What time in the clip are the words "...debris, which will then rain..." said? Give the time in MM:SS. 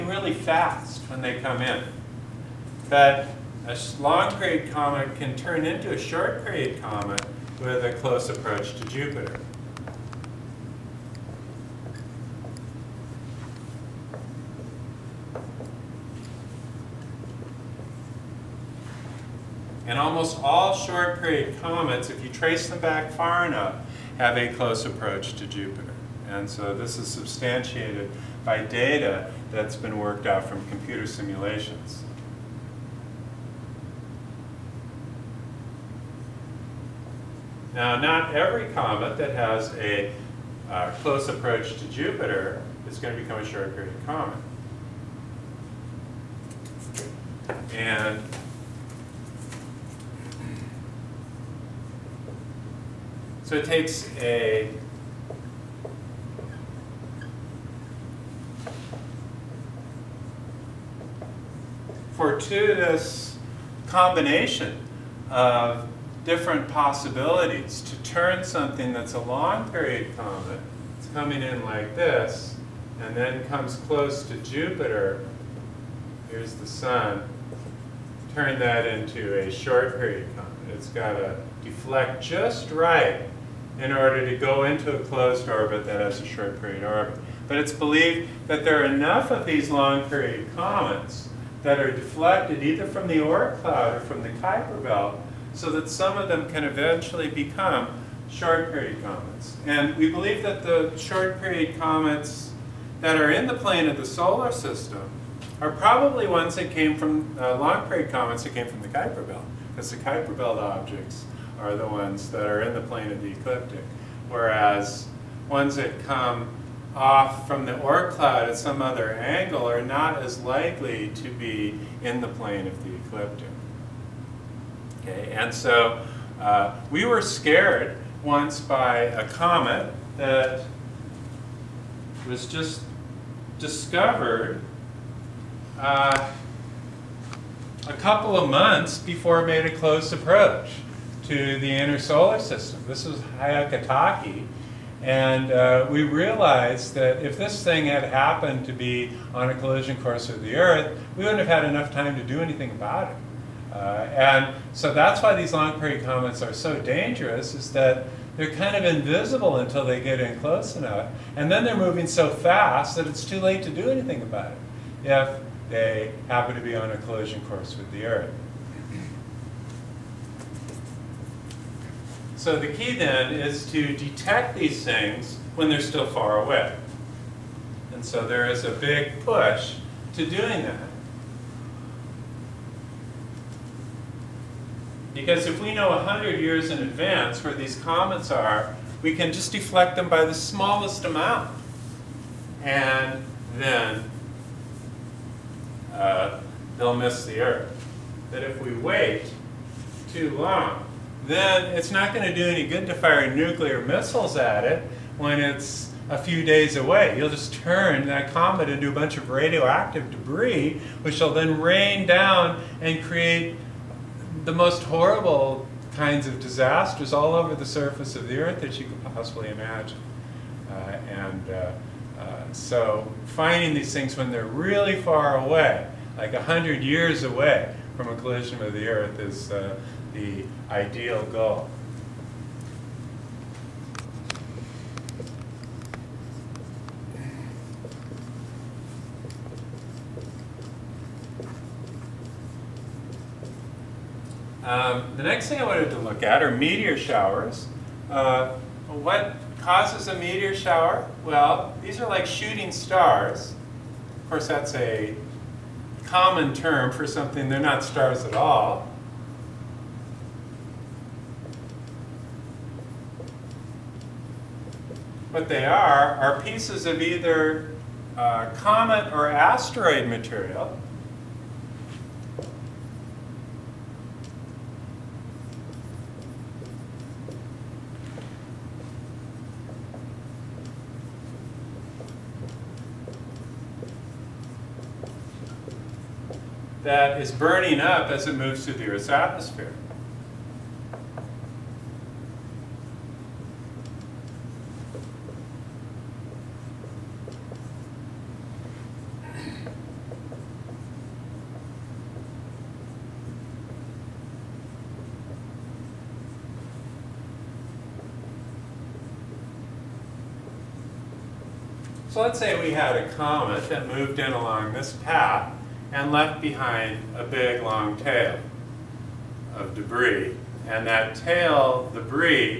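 03:30.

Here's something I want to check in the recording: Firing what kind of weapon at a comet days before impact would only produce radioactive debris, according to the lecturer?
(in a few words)
nuclear missiles.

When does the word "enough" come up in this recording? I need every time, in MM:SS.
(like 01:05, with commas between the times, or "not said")
00:23, 01:28, 02:31, 02:40.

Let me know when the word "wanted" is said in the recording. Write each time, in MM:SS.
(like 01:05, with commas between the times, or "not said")
04:05.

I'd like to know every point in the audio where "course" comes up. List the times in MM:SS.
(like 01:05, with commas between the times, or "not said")
02:30, 02:47, 04:14.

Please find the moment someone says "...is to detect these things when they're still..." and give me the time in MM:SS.
02:53.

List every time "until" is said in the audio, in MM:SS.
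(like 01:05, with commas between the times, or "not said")
02:39.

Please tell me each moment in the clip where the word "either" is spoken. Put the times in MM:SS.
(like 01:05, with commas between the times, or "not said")
01:32, 04:27.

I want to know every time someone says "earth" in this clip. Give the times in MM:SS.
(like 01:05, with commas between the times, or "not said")
02:30, 02:48, 03:17, 03:38, 03:48, 04:48.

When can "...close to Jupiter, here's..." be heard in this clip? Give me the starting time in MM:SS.
01:13.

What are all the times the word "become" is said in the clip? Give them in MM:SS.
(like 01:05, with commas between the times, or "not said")
00:43, 01:37.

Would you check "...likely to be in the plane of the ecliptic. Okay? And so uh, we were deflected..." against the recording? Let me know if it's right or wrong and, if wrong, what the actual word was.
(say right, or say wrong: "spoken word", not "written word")
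wrong: "scared", not "deflected".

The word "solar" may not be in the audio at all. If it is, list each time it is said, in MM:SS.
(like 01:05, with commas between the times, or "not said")
01:44, 02:21.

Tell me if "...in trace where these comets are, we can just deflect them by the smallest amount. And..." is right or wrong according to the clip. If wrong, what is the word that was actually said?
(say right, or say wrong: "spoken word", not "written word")
wrong: "advance", not "trace".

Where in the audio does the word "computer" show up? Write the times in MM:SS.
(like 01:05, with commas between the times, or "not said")
00:30.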